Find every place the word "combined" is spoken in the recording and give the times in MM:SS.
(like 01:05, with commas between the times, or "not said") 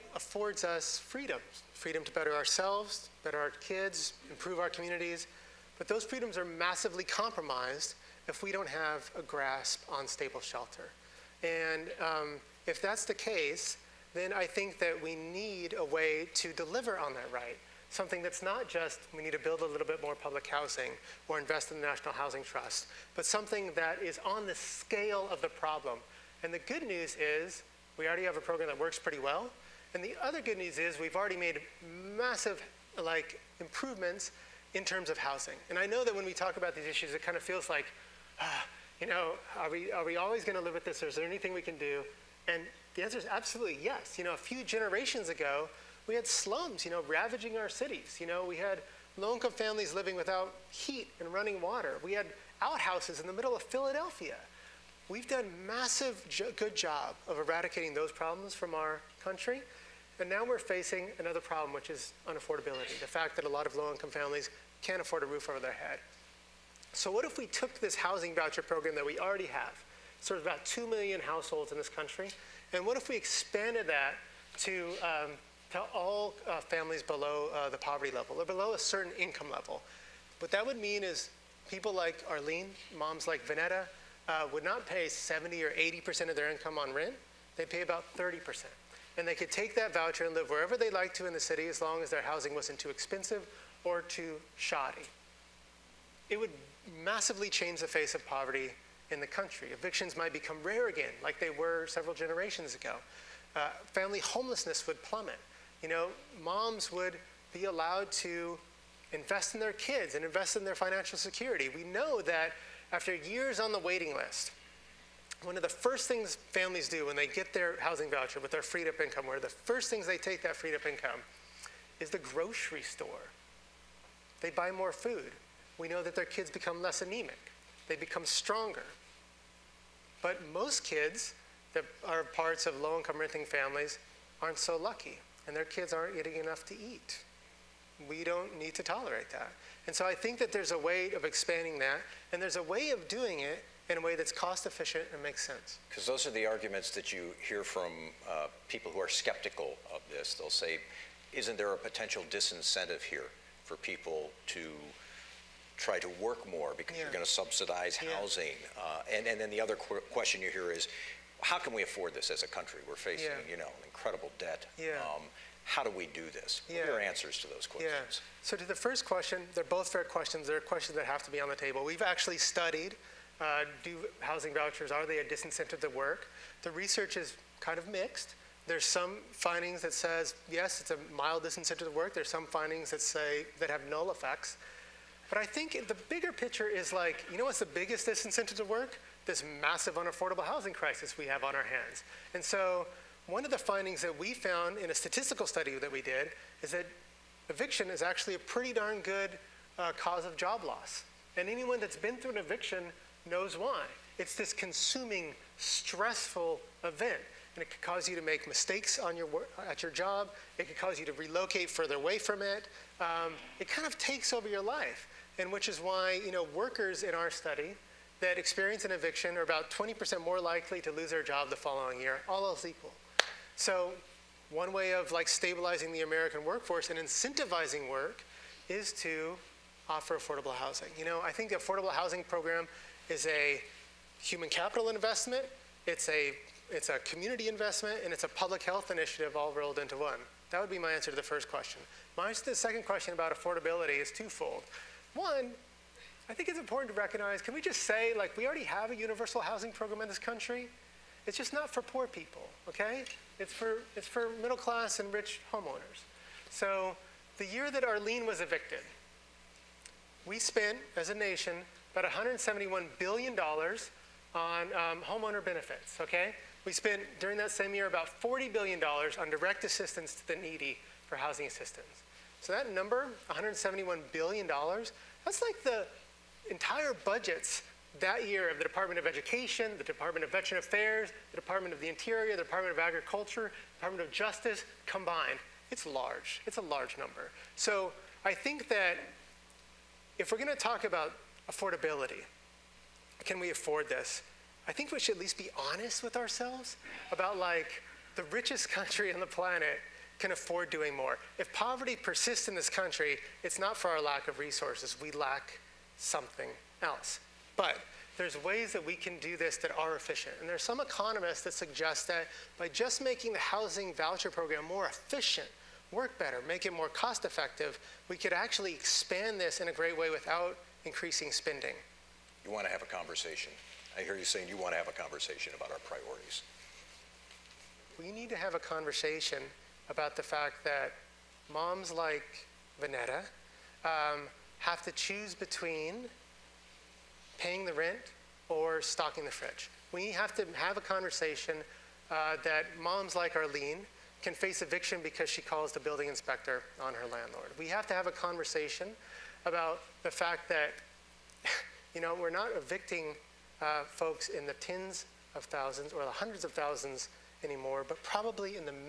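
04:44.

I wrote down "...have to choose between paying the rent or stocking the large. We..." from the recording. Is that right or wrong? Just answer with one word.
wrong.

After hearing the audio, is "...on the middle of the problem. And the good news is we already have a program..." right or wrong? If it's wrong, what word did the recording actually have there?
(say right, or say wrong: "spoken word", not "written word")
wrong: "scale", not "middle".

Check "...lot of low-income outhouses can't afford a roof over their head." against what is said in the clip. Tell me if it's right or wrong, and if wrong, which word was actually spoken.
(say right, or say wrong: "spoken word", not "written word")
wrong: "families", not "outhouses".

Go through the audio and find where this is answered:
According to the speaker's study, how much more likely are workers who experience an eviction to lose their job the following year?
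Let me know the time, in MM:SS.
03:39.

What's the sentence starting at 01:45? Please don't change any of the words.
You know, moms would be allowed to invest in their kids and invest in their financial security.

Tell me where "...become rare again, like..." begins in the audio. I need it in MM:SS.
01:40.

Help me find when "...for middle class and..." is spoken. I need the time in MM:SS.
04:14.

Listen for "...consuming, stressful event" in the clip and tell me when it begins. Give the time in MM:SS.
03:24.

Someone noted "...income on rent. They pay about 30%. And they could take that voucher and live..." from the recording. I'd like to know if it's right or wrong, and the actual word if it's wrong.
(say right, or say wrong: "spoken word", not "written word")
right.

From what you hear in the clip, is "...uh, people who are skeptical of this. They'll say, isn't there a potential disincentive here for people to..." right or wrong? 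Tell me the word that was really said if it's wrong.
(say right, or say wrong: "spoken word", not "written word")
right.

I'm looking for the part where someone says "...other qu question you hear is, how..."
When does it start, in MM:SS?
02:39.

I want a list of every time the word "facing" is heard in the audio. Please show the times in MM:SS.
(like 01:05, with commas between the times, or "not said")
01:00, 02:42.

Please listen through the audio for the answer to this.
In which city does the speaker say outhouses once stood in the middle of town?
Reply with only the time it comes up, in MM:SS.
00:53.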